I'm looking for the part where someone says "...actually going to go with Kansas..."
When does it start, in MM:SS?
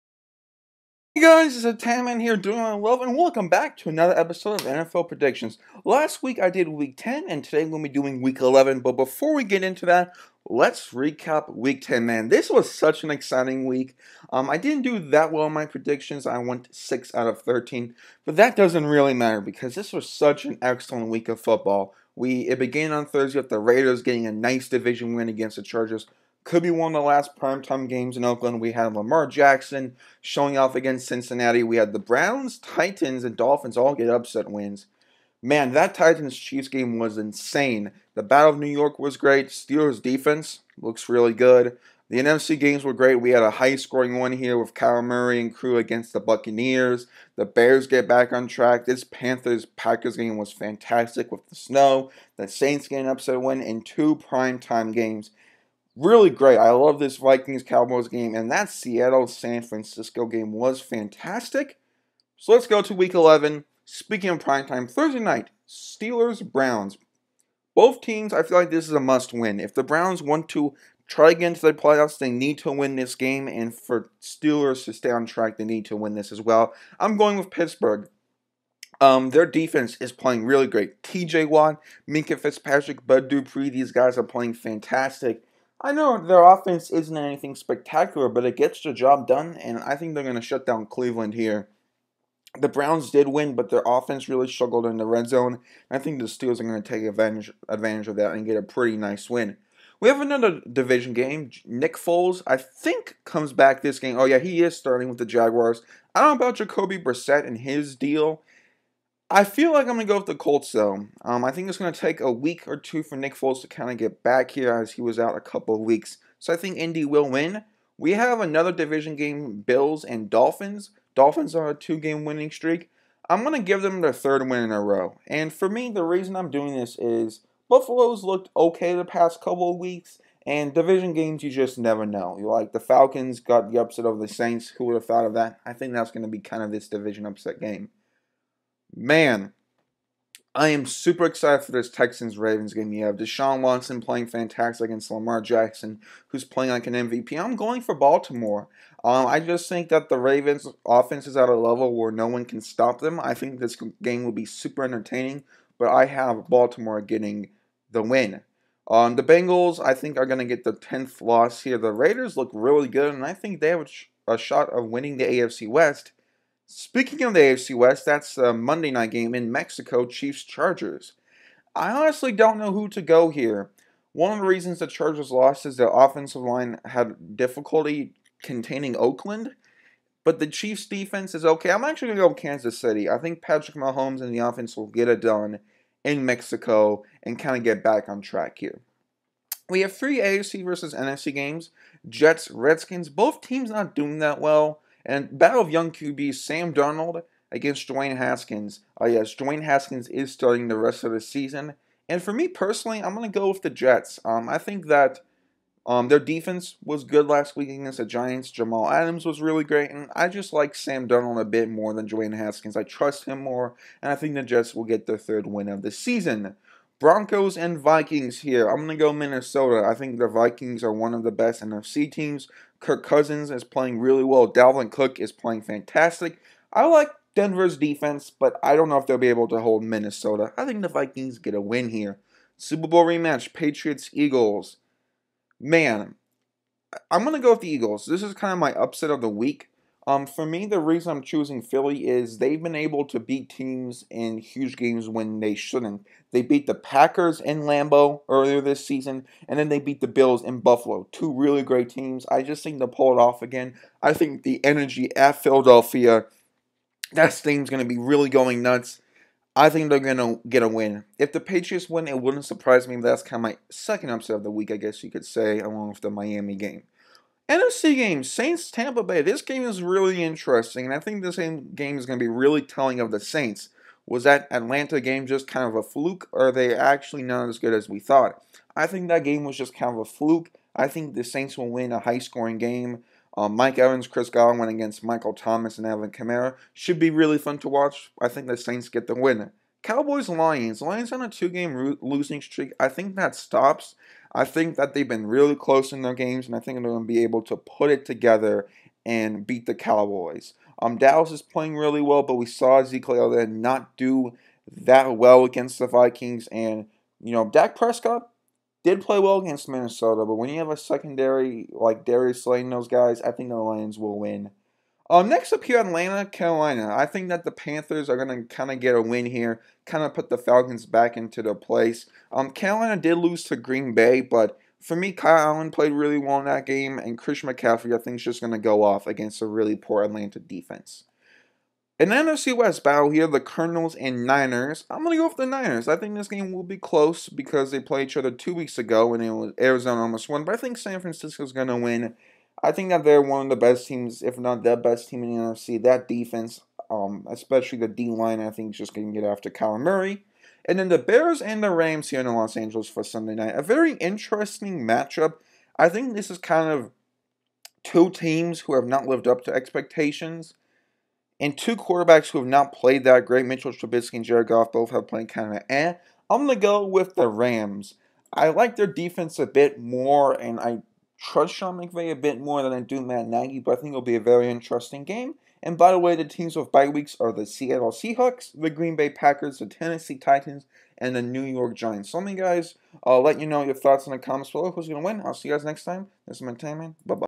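03:01.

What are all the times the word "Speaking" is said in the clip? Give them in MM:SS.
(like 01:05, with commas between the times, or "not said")
01:03, 02:46.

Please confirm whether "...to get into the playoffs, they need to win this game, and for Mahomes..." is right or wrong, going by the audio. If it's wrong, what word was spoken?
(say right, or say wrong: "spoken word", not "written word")
wrong: "Steelers", not "Mahomes".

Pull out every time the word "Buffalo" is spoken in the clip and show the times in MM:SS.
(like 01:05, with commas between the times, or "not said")
02:07, 04:10.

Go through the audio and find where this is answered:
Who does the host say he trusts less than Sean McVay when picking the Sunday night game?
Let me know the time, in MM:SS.
06:13.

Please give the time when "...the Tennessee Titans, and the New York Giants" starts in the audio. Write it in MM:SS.
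06:19.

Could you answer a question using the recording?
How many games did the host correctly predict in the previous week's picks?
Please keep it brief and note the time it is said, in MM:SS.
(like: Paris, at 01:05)
6 out of 13, at 00:16.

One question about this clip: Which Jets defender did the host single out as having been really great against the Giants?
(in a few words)
Jamal Adams.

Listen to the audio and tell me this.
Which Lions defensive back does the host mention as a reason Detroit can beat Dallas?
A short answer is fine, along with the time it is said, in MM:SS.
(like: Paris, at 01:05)
Darius Slay, at 05:12.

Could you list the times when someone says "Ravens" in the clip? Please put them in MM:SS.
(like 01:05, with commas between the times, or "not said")
02:22, 02:30.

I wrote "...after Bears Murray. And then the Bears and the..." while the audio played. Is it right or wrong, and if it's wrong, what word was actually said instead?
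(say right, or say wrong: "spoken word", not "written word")
wrong: "Kyler", not "Bears".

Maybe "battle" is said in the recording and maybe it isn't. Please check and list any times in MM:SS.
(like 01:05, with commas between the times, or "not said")
00:38, 03:15, 05:32.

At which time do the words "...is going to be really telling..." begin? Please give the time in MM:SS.
04:31.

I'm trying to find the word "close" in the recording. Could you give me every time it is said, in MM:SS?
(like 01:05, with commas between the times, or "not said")
04:55, 05:36.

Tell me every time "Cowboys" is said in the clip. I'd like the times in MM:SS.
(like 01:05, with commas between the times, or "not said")
00:57, 04:49, 04:59.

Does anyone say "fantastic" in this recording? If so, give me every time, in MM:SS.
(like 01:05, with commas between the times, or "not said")
00:50, 01:00, 01:24, 02:24, 03:45.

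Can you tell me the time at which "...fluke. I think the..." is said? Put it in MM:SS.
04:40.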